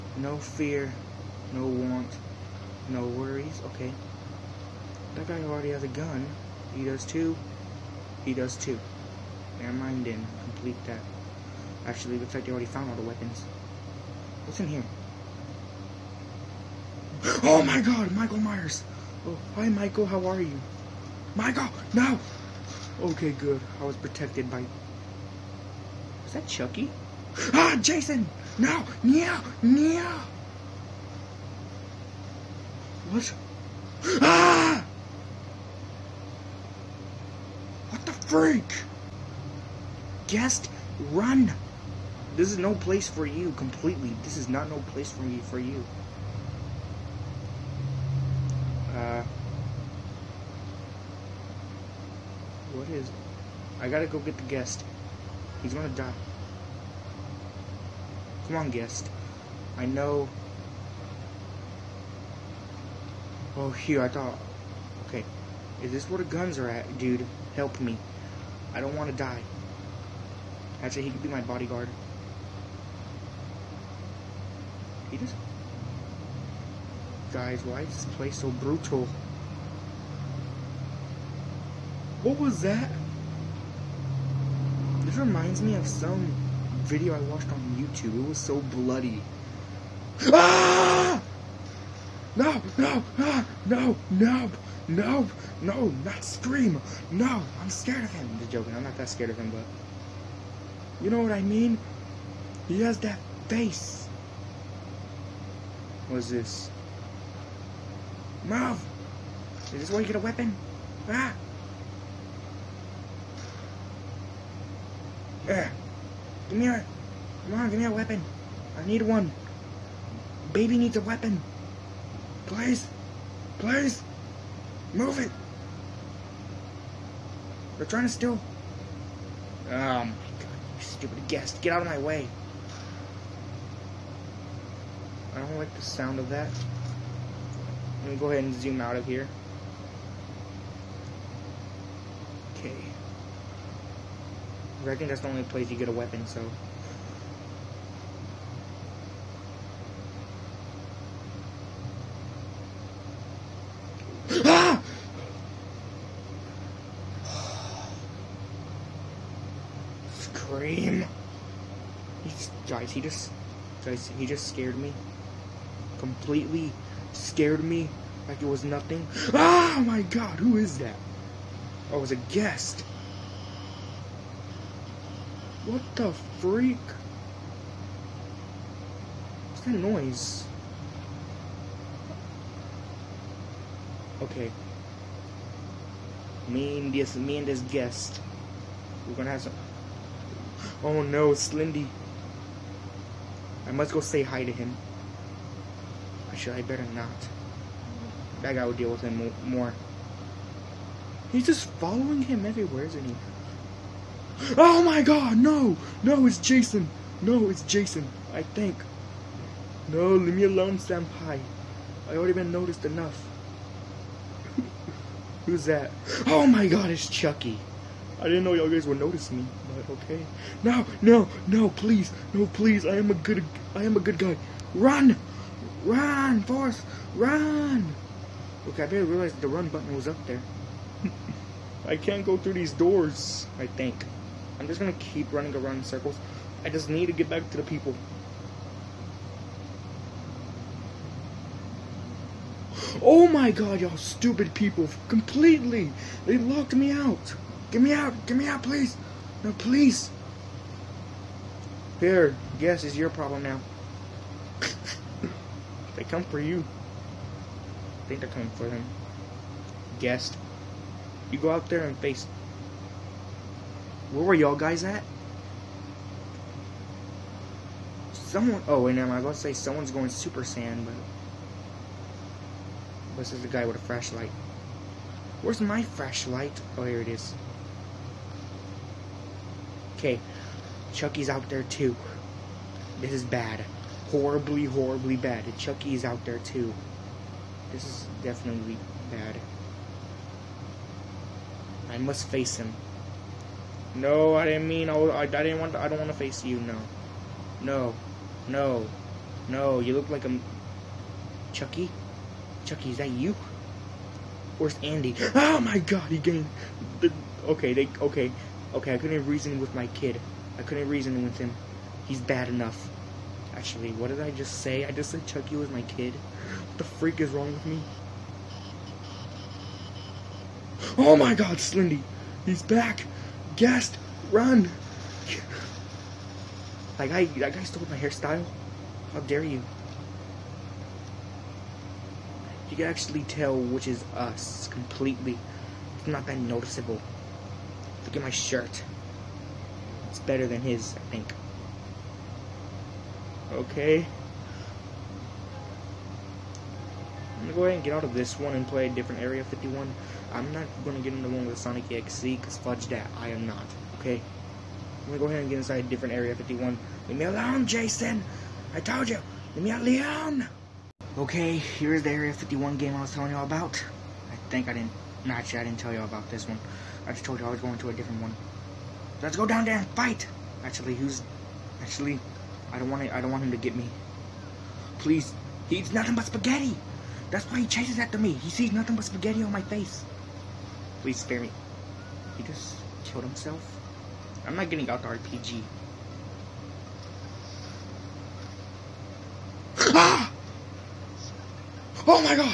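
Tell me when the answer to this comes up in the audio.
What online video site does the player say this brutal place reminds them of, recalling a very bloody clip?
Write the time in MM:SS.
01:27.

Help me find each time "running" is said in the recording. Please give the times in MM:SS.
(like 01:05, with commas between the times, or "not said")
03:55.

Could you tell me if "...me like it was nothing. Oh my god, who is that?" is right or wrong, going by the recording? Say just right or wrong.
right.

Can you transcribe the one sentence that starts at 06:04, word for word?
I think I didn't, no, actually I didn't tell y'all about this one.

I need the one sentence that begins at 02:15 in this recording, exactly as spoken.
I don't like the sound of that.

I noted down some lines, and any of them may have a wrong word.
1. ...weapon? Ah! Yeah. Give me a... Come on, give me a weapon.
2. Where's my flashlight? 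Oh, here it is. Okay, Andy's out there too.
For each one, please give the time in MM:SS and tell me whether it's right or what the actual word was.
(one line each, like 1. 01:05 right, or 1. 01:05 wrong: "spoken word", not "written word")
1. 01:50 right
2. 04:35 wrong: "Chucky", not "Andy".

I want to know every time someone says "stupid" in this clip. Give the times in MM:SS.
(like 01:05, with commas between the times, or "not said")
02:10, 04:03.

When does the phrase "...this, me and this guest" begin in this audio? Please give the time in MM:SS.
03:06.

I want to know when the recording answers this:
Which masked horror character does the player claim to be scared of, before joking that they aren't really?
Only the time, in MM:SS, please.
01:36.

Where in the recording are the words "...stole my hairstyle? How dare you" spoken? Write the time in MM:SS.
05:27.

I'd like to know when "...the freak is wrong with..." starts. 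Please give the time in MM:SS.
05:16.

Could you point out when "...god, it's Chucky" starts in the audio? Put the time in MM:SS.
03:36.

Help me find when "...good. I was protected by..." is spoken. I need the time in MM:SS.
00:23.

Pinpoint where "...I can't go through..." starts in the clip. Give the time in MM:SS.
03:51.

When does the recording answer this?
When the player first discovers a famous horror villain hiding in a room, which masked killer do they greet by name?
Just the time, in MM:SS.
00:18.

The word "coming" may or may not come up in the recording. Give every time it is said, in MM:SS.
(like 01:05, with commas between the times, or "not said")
04:18.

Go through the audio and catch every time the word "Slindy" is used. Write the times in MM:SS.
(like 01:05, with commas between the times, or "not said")
03:11, 05:21.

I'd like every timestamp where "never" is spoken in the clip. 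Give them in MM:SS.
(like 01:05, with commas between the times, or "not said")
00:09, 04:28.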